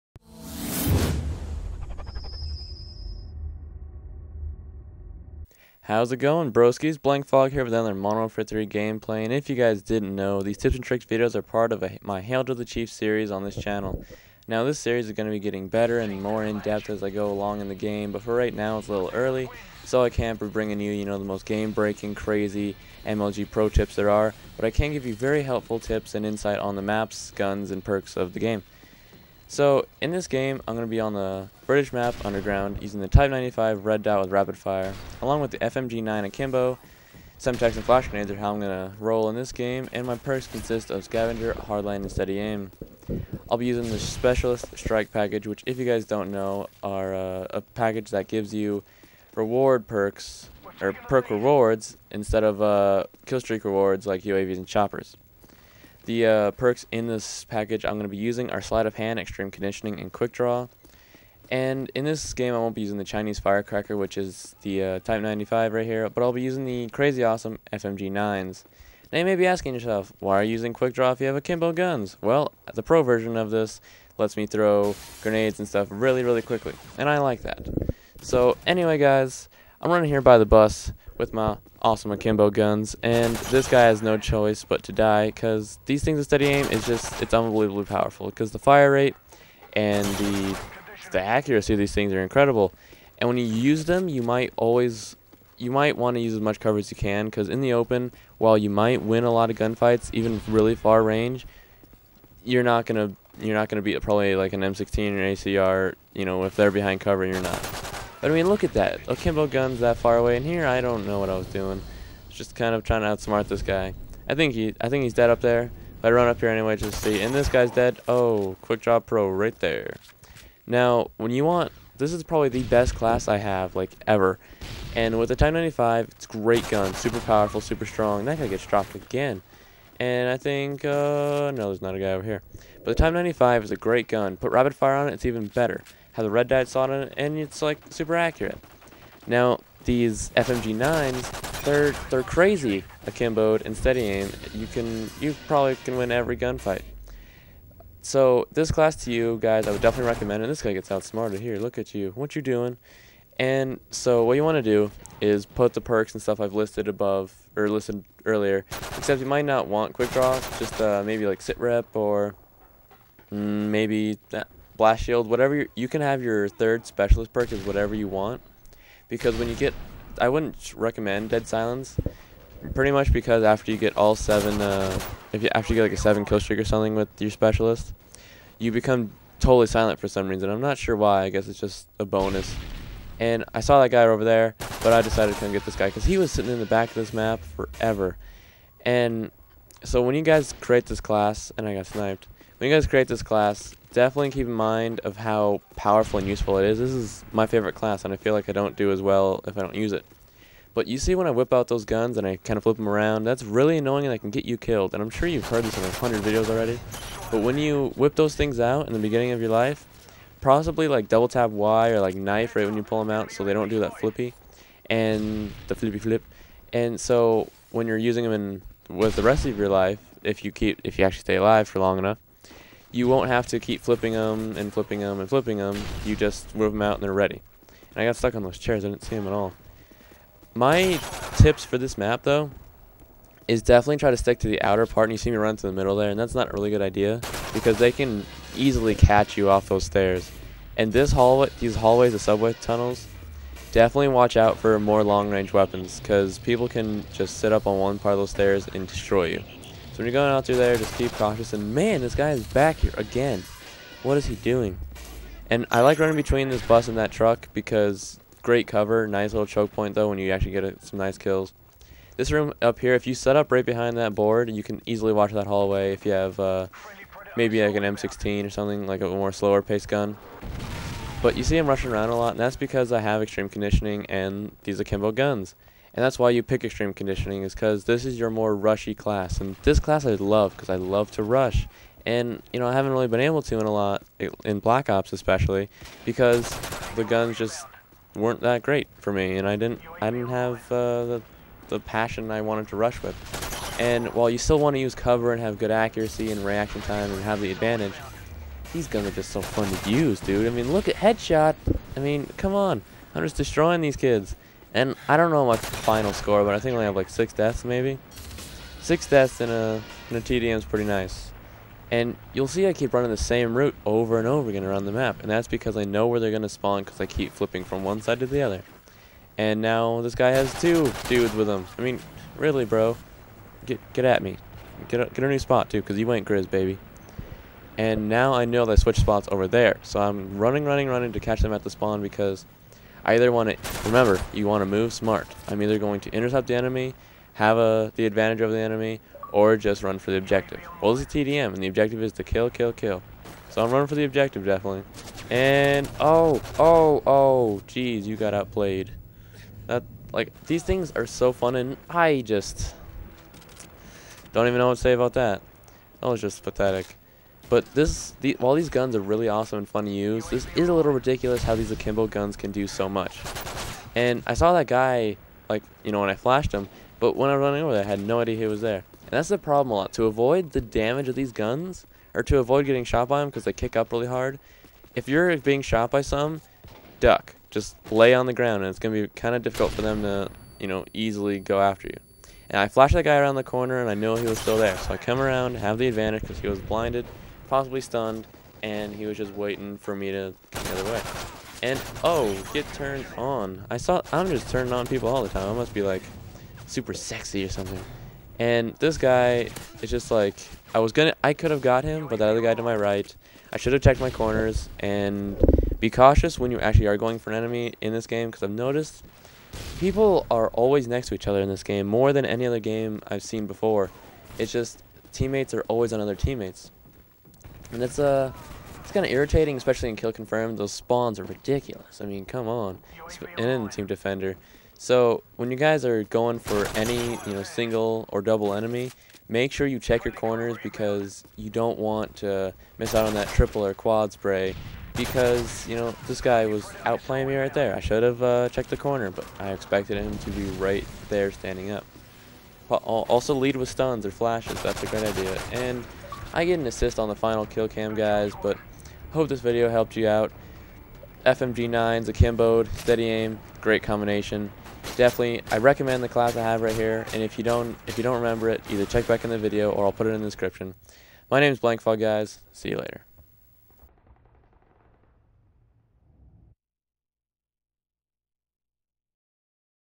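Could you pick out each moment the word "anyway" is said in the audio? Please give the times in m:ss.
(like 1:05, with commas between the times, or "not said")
1:18, 1:56.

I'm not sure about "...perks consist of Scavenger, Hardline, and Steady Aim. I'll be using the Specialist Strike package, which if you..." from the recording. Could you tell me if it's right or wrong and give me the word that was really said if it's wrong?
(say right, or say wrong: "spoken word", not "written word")
right.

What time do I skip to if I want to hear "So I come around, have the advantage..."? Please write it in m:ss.
6:24.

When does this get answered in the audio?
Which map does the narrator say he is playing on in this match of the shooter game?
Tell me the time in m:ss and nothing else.
0:32.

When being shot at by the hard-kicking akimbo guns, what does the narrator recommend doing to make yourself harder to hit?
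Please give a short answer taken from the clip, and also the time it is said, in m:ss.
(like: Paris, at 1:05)
duck, at 6:17.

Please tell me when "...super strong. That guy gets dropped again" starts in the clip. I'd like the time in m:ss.
2:07.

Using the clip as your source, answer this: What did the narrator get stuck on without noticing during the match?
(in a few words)
chairs.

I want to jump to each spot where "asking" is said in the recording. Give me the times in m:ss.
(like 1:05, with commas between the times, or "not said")
1:09.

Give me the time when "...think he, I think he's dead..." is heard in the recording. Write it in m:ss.
1:54.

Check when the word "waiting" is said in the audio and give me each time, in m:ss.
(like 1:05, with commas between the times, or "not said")
6:29.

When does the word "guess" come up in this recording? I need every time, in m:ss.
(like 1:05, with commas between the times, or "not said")
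3:01.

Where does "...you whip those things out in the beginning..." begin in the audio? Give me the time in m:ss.
3:27.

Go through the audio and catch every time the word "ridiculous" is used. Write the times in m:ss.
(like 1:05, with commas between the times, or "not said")
6:00, 7:01.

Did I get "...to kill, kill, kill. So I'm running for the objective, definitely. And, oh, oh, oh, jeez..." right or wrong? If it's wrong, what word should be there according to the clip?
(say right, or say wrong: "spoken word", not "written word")
right.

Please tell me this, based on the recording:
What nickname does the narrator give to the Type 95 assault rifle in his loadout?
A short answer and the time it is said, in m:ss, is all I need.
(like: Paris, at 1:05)
Chinese Firecracker, at 1:03.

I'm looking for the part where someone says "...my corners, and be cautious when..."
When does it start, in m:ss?
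6:43.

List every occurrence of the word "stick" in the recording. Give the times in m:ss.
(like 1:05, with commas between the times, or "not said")
3:54.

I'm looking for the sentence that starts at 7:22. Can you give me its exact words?
Also lead with stuns or flashes.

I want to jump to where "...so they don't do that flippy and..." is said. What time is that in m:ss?
3:33.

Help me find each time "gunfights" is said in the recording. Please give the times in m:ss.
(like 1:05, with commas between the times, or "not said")
1:39, 2:26.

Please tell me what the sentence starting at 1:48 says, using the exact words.
But I mean, look at that.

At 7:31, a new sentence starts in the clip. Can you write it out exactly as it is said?
FMG9's akimboed, steady aim, great combination.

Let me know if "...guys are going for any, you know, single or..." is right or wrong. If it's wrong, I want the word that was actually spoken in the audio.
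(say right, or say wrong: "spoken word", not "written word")
right.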